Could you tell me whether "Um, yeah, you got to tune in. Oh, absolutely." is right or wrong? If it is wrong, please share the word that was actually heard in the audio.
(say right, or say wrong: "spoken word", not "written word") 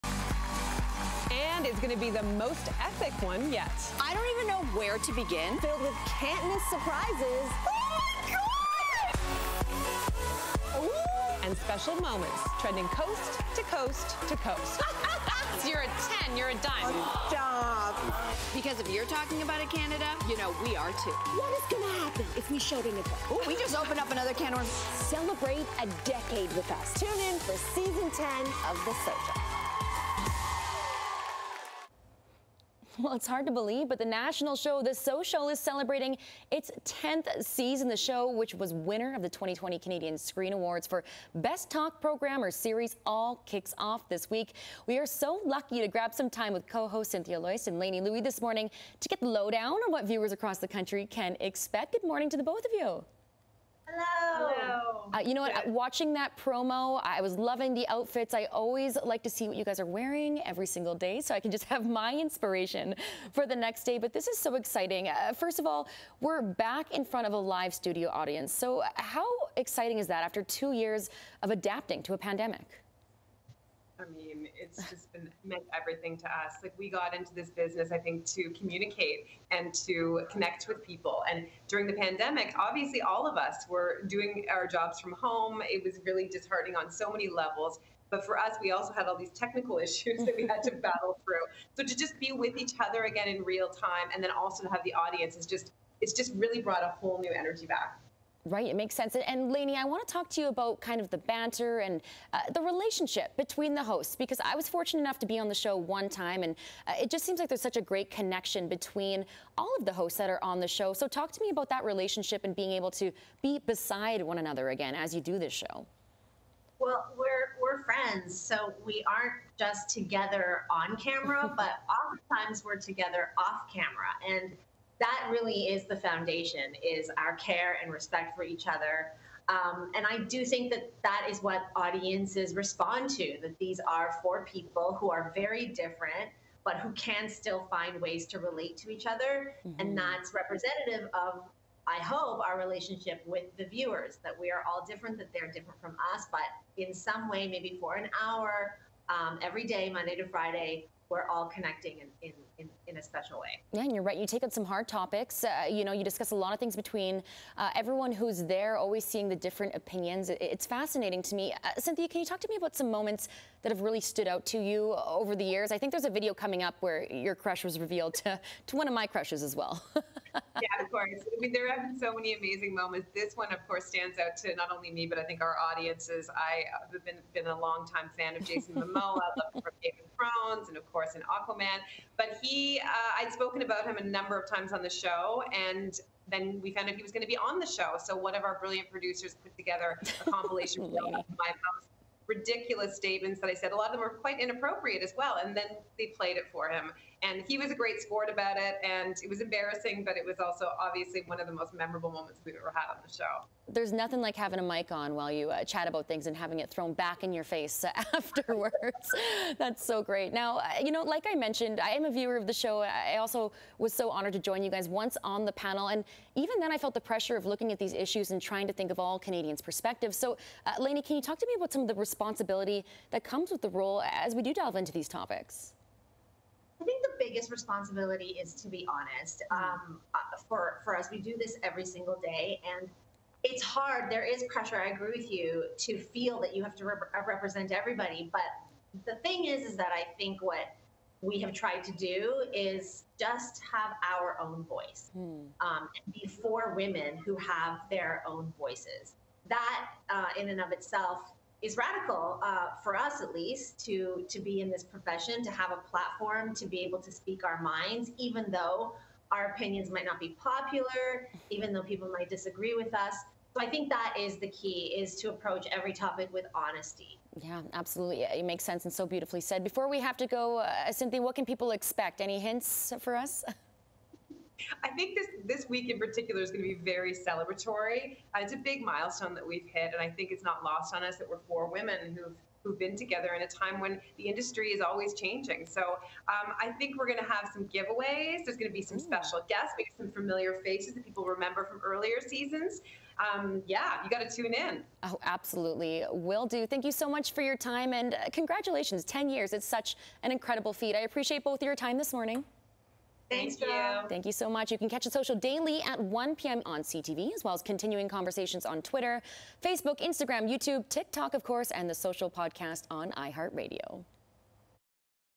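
right.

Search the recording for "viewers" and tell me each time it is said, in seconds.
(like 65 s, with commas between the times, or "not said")
50 s, 143 s, 212 s.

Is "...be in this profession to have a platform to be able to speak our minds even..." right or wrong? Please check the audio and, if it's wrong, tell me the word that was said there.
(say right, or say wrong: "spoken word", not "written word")
right.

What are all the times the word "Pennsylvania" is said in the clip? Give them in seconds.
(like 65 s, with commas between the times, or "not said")
not said.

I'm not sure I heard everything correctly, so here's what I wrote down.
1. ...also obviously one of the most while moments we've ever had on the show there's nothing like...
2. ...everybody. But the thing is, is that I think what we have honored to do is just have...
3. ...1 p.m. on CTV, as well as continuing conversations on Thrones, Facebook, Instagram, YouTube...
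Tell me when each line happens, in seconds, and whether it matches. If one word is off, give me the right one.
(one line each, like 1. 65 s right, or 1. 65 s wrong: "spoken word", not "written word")
1. 200 s wrong: "memorable", not "while"
2. 237 s wrong: "tried", not "honored"
3. 305 s wrong: "Twitter", not "Thrones".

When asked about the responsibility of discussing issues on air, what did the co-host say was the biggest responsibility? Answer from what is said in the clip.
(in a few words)
To be honest.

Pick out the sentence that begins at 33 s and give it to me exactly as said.
Well, it's hard to believe, but the national show The Social is celebrating its 10th season.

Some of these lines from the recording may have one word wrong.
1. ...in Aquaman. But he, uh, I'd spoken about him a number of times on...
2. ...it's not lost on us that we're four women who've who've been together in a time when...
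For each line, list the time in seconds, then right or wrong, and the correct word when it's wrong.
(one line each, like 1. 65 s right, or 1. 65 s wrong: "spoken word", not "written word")
1. 181 s right
2. 280 s right.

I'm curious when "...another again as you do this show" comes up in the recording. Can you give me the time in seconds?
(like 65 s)
114 s.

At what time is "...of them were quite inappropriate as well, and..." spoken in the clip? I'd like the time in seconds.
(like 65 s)
193 s.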